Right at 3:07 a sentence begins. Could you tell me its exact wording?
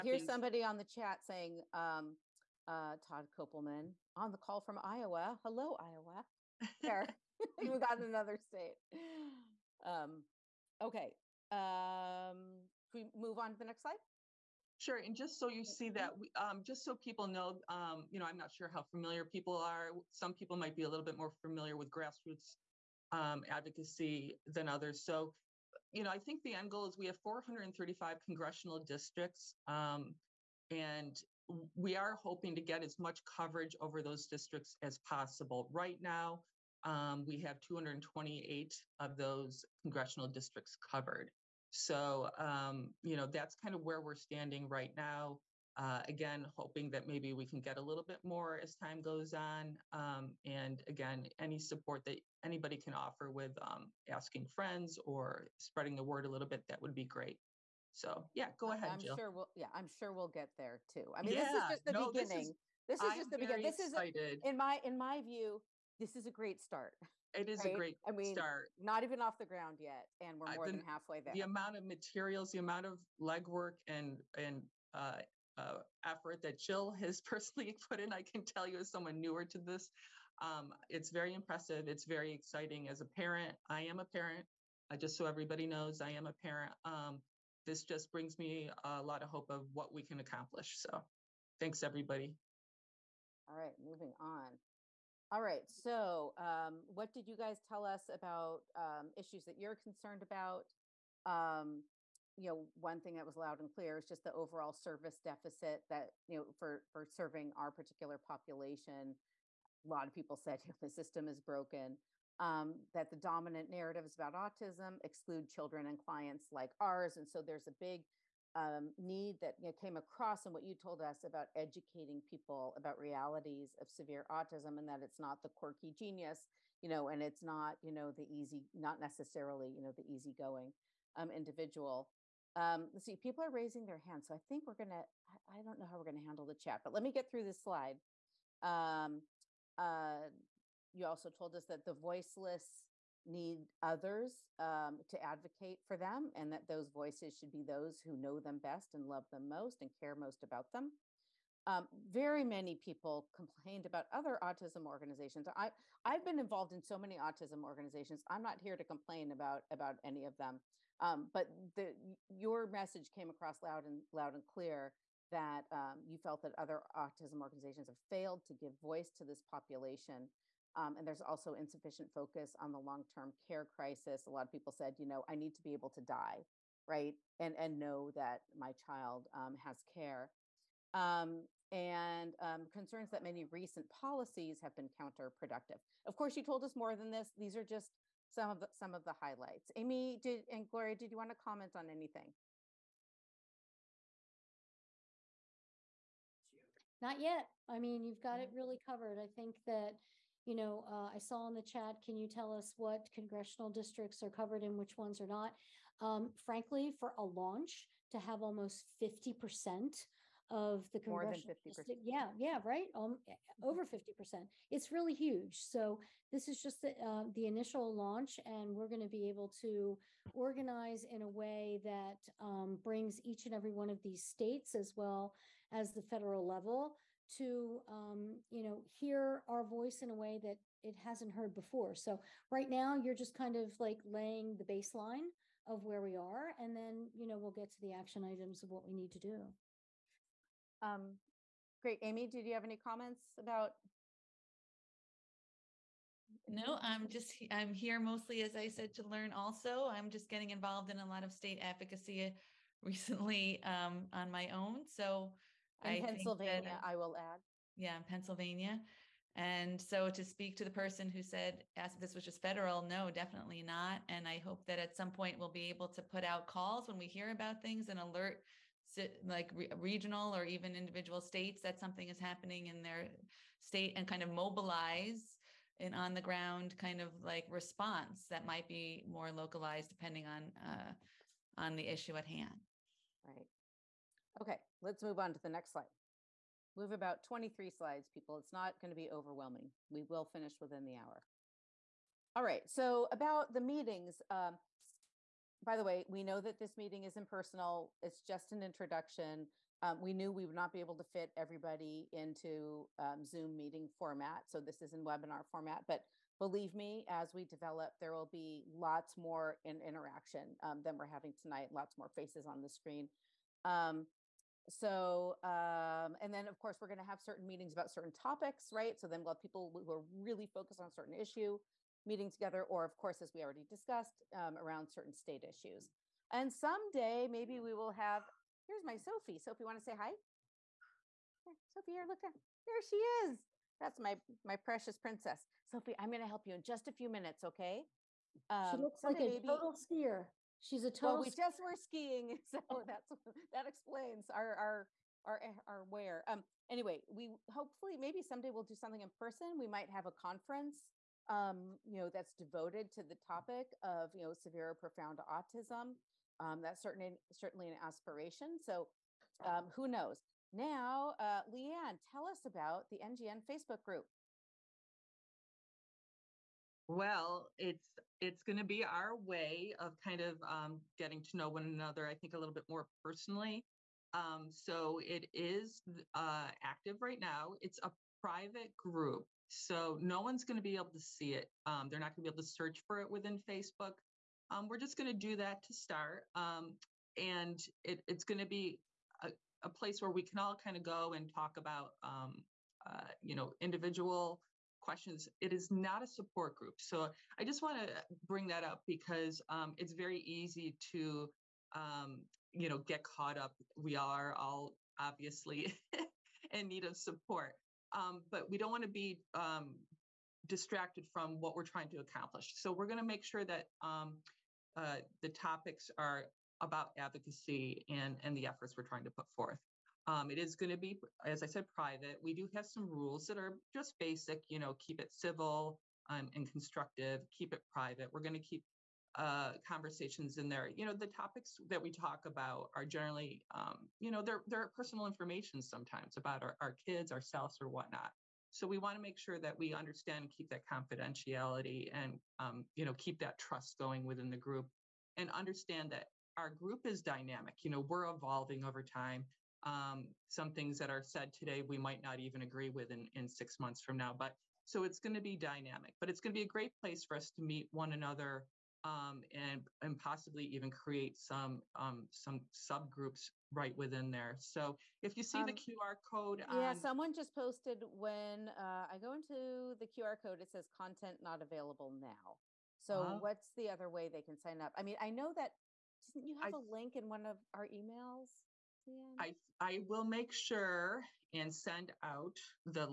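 These are just some of the, some of the highlights.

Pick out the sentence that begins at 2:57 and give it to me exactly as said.
And, and know that my child um, has care.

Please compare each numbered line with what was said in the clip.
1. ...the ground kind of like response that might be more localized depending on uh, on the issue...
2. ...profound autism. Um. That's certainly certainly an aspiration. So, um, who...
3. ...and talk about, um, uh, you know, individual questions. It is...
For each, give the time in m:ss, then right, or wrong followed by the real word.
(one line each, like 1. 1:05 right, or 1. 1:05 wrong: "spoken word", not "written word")
1. 4:36 right
2. 5:54 right
3. 6:31 right.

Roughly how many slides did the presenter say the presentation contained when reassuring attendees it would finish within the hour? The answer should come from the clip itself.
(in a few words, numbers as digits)
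23.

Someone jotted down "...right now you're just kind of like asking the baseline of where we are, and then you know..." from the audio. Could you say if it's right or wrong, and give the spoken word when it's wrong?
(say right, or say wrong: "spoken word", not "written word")
wrong: "laying", not "asking".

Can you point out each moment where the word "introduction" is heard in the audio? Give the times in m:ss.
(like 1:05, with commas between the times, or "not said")
4:58.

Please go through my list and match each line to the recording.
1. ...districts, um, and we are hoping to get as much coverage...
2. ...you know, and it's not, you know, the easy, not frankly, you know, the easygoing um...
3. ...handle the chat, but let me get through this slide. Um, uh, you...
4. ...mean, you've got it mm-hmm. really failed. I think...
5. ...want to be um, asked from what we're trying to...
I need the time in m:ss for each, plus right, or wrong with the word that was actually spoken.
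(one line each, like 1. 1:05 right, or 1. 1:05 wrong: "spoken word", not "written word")
1. 0:28 right
2. 2:06 wrong: "necessarily", not "frankly"
3. 2:16 right
4. 3:17 wrong: "covered", not "failed"
5. 6:48 wrong: "distracted", not "asked".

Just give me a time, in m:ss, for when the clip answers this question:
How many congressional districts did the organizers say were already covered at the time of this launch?
0:37.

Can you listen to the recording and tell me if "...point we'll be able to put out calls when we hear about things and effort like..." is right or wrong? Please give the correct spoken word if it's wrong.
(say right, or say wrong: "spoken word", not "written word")
wrong: "alert", not "effort".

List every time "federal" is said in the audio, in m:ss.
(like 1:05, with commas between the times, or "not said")
3:46, 4:22.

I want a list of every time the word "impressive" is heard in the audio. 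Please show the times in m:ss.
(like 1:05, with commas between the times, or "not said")
1:21.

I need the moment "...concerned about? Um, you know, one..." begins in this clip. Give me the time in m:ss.
1:39.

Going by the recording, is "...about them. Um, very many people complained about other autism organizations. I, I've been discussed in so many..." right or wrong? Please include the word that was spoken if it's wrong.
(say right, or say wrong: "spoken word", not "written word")
wrong: "involved", not "discussed".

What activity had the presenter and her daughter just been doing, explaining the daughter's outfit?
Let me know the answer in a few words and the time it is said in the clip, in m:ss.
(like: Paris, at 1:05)
Skiing, at 5:41.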